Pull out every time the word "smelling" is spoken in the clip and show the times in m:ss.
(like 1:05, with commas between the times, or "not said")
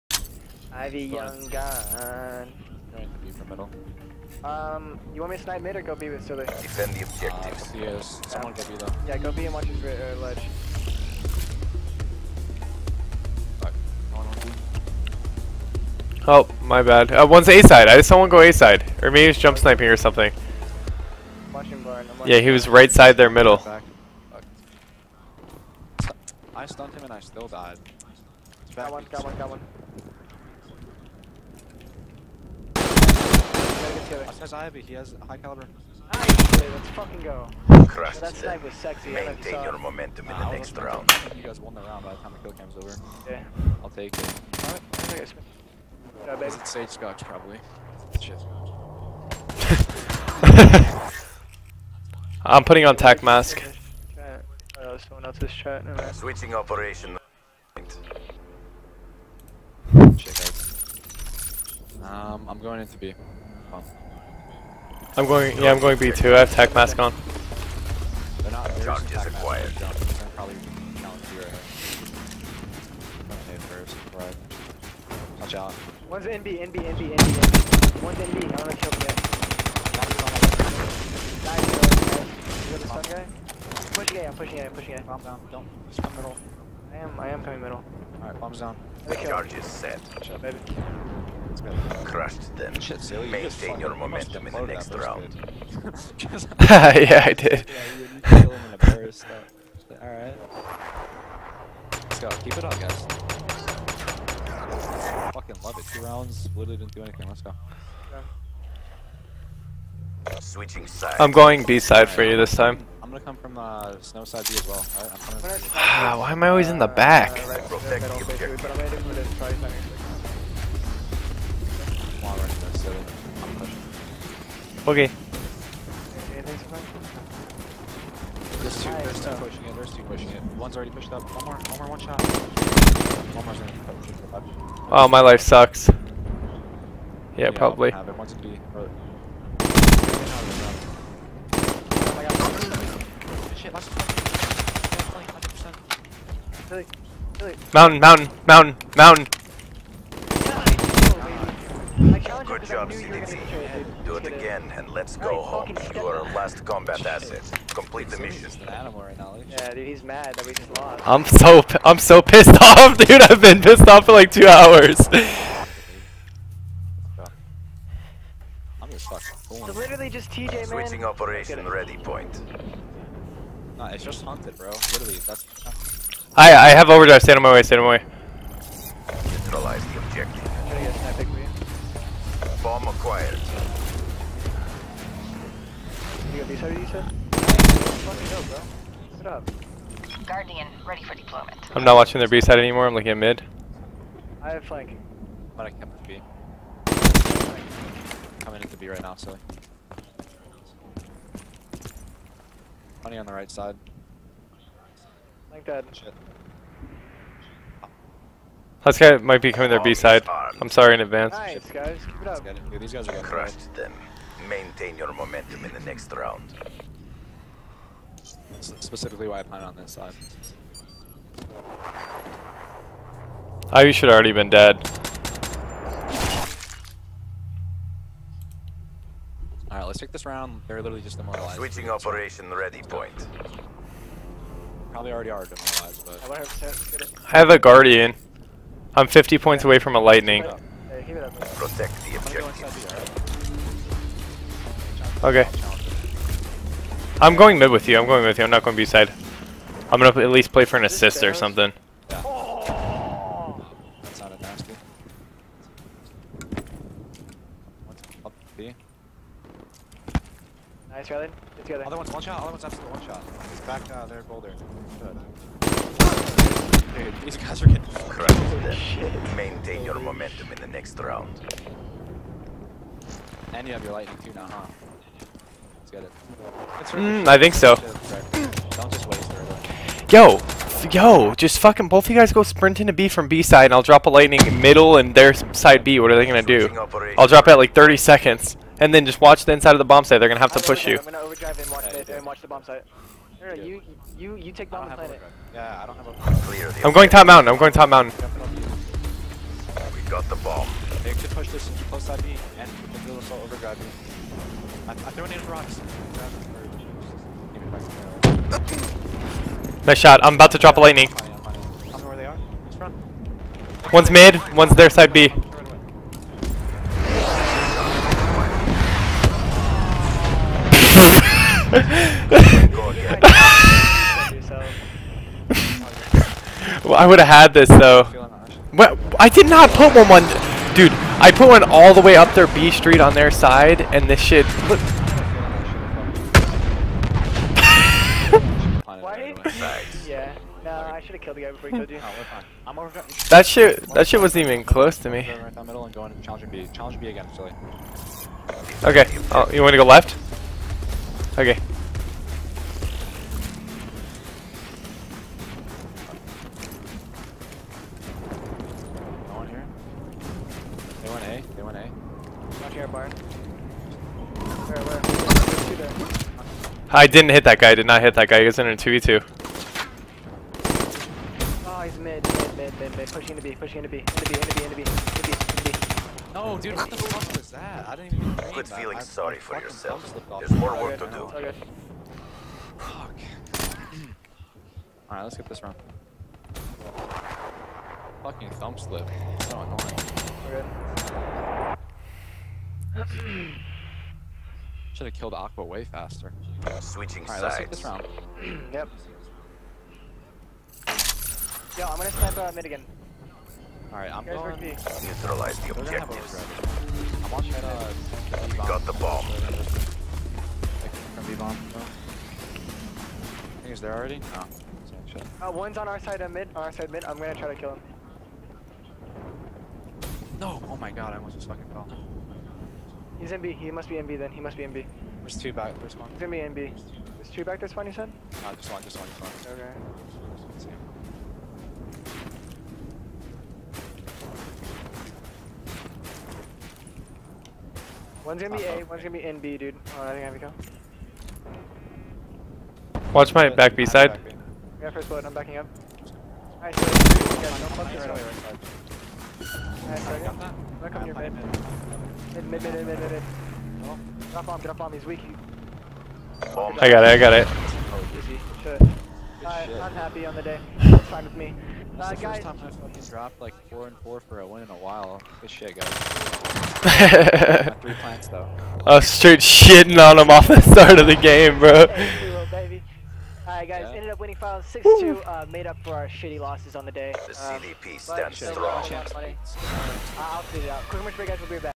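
not said.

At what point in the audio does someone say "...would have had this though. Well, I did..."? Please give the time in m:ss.
5:27.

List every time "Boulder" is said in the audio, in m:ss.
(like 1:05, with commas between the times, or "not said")
4:24.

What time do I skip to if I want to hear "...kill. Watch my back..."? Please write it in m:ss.
7:20.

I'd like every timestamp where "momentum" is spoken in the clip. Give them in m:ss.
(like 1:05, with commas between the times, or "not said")
0:39, 1:33, 3:35, 4:29.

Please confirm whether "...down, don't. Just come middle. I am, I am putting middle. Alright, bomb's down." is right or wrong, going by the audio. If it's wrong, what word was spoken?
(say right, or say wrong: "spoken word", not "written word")
wrong: "coming", not "putting".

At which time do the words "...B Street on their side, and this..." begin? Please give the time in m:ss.
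5:32.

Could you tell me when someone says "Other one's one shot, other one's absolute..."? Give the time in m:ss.
4:21.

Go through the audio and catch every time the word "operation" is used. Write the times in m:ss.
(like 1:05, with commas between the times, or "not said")
0:56, 2:51, 3:51.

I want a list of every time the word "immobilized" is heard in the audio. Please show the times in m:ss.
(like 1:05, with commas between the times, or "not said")
3:51, 3:55.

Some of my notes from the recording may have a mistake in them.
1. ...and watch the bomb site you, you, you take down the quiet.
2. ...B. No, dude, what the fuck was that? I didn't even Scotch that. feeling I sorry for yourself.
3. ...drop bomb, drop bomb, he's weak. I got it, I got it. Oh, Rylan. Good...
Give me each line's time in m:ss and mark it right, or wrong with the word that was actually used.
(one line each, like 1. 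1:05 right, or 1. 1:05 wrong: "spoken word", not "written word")
1. 4:52 wrong: "planet", not "quiet"
2. 6:15 wrong: "Quit", not "Scotch"
3. 7:34 wrong: "Shit", not "Rylan".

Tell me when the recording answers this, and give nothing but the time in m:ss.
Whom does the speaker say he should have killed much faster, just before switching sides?
6:34.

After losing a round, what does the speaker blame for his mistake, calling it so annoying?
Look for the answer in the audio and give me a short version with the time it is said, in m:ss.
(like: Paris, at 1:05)
Thumb slip, at 6:28.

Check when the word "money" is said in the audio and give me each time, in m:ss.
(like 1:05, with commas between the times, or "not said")
3:23.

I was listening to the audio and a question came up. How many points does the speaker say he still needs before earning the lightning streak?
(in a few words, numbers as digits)
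50.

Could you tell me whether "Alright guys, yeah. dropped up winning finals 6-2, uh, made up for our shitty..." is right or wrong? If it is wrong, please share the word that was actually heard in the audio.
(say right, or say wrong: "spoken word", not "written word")
wrong: "ended", not "dropped".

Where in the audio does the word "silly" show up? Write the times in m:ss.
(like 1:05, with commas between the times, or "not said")
0:06, 3:19.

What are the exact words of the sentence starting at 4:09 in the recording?
I'm gonna at least play for an assist or something.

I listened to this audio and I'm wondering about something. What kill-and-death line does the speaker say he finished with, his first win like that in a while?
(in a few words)
4 and 4.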